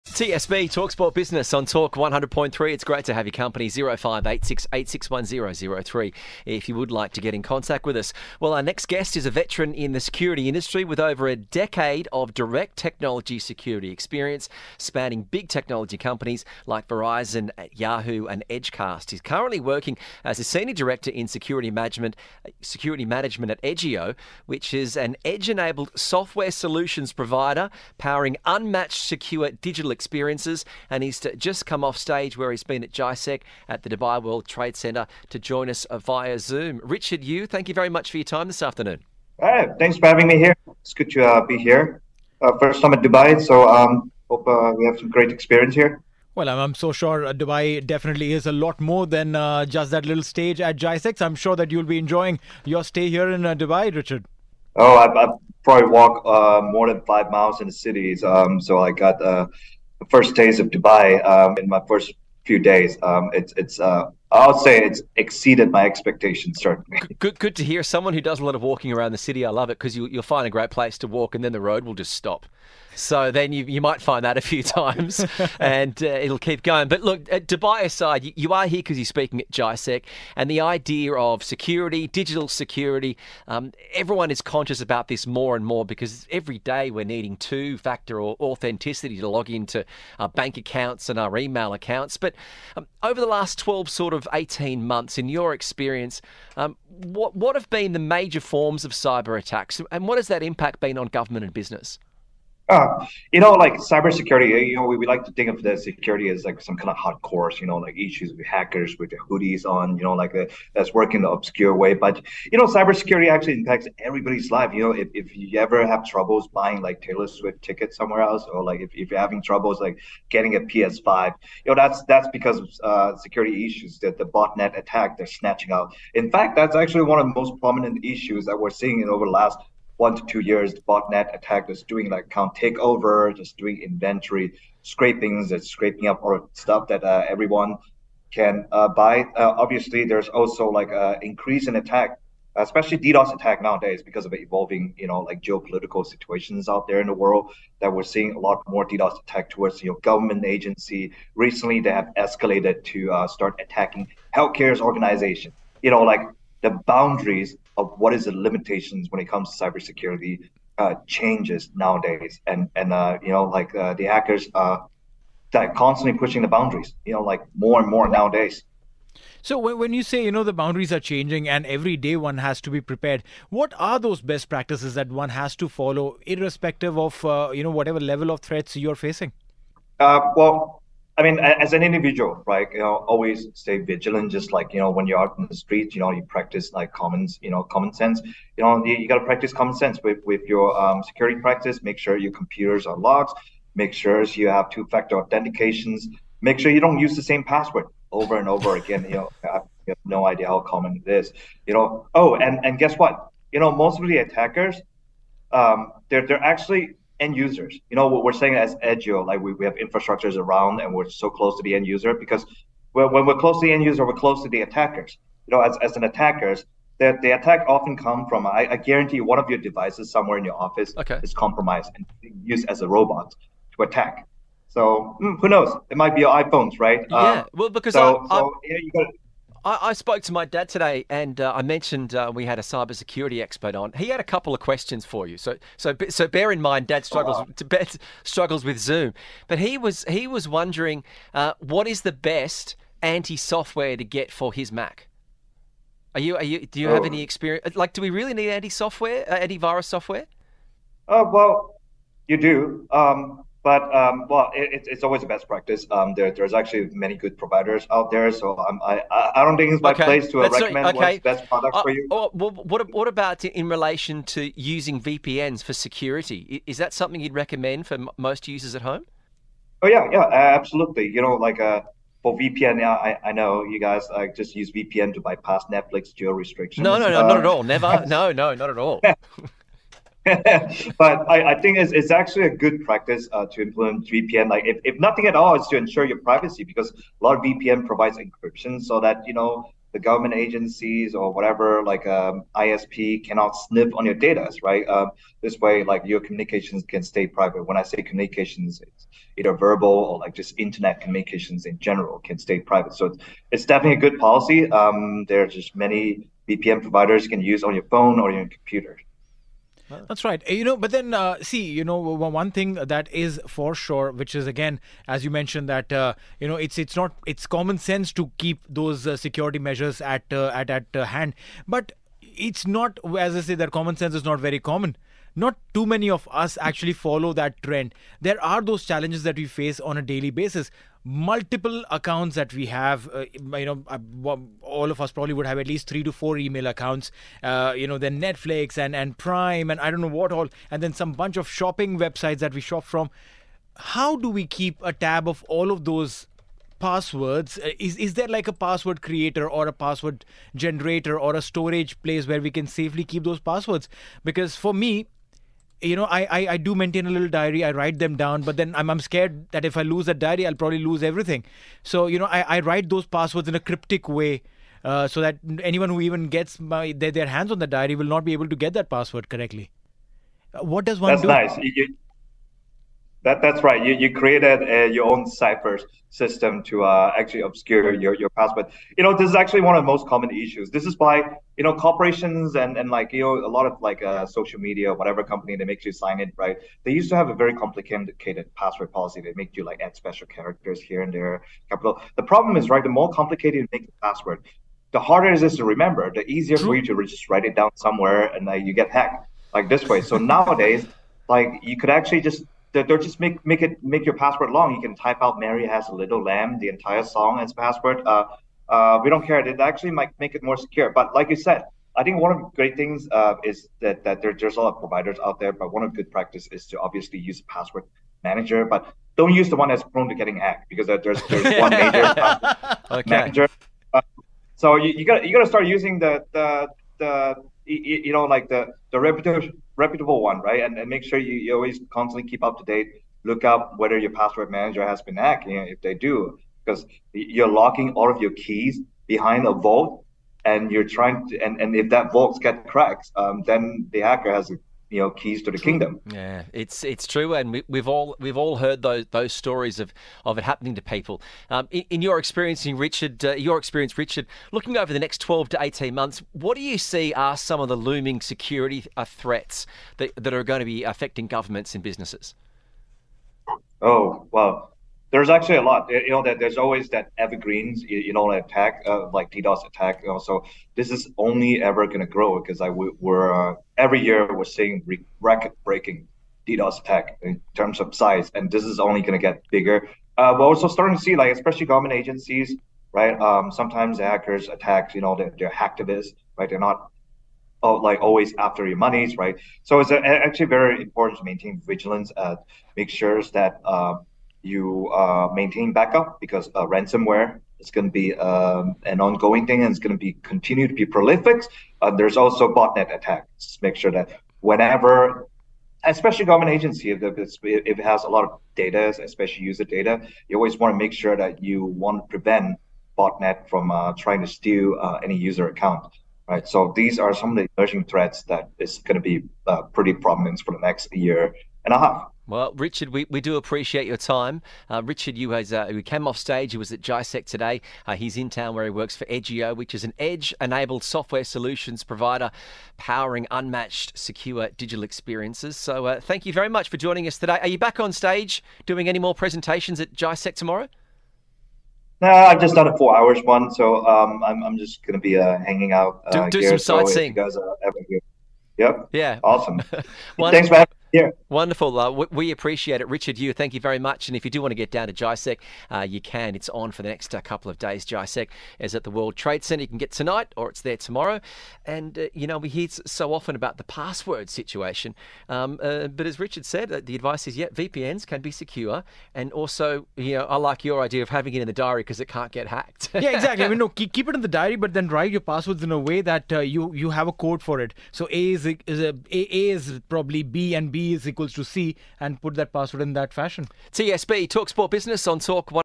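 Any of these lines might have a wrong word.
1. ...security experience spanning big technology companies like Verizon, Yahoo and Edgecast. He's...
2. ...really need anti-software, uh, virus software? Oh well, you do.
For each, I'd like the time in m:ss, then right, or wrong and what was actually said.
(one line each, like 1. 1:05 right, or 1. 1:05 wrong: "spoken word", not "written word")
1. 0:13 right
2. 4:08 right.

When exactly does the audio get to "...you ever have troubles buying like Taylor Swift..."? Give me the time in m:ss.
1:55.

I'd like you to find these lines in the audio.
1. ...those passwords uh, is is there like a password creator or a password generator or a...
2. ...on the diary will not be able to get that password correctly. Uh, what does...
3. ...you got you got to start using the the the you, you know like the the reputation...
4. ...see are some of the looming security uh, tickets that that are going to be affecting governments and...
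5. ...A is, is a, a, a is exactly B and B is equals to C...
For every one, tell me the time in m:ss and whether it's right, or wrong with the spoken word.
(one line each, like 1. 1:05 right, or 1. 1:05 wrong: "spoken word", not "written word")
1. 5:45 right
2. 6:07 right
3. 7:04 right
4. 7:36 wrong: "threats", not "tickets"
5. 9:38 wrong: "probably", not "exactly".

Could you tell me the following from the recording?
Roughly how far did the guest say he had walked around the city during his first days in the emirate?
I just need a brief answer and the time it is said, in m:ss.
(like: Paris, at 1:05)
more than 5 miles, at 0:56.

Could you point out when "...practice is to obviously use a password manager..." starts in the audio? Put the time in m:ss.
6:56.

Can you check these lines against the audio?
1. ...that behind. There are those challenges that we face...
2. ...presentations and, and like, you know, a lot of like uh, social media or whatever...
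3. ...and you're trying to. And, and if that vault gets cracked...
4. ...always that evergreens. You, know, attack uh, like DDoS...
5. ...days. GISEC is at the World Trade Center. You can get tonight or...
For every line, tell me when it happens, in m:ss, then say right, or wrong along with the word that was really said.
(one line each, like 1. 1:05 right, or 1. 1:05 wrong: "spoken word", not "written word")
1. 5:27 wrong: "trend", not "behind"
2. 6:21 wrong: "corporations", not "presentations"
3. 7:20 right
4. 7:46 right
5. 9:17 right.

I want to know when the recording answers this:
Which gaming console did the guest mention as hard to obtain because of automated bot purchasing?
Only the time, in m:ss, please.
2:00.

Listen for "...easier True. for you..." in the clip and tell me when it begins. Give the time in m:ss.
6:36.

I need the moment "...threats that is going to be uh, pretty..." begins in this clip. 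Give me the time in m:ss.
8:37.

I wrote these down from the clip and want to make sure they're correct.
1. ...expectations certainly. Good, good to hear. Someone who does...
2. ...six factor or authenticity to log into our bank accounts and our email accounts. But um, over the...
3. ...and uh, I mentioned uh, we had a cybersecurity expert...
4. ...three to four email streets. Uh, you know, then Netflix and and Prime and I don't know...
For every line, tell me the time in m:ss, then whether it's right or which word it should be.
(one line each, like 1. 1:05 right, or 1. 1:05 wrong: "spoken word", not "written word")
1. 1:05 right
2. 1:27 wrong: "two", not "six"
3. 3:51 right
4. 5:35 wrong: "accounts", not "streets".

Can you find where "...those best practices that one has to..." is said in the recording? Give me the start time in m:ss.
2:53.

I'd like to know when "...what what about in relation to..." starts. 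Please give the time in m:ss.
4:22.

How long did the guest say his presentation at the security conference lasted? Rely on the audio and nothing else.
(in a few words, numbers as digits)
4 hours.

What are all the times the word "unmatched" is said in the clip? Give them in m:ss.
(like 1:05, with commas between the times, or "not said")
0:28, 8:53.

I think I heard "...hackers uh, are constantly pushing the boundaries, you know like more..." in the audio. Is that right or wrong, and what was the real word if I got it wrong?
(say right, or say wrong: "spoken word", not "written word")
right.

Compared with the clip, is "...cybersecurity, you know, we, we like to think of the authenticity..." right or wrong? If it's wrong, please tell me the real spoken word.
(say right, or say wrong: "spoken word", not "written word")
wrong: "security", not "authenticity".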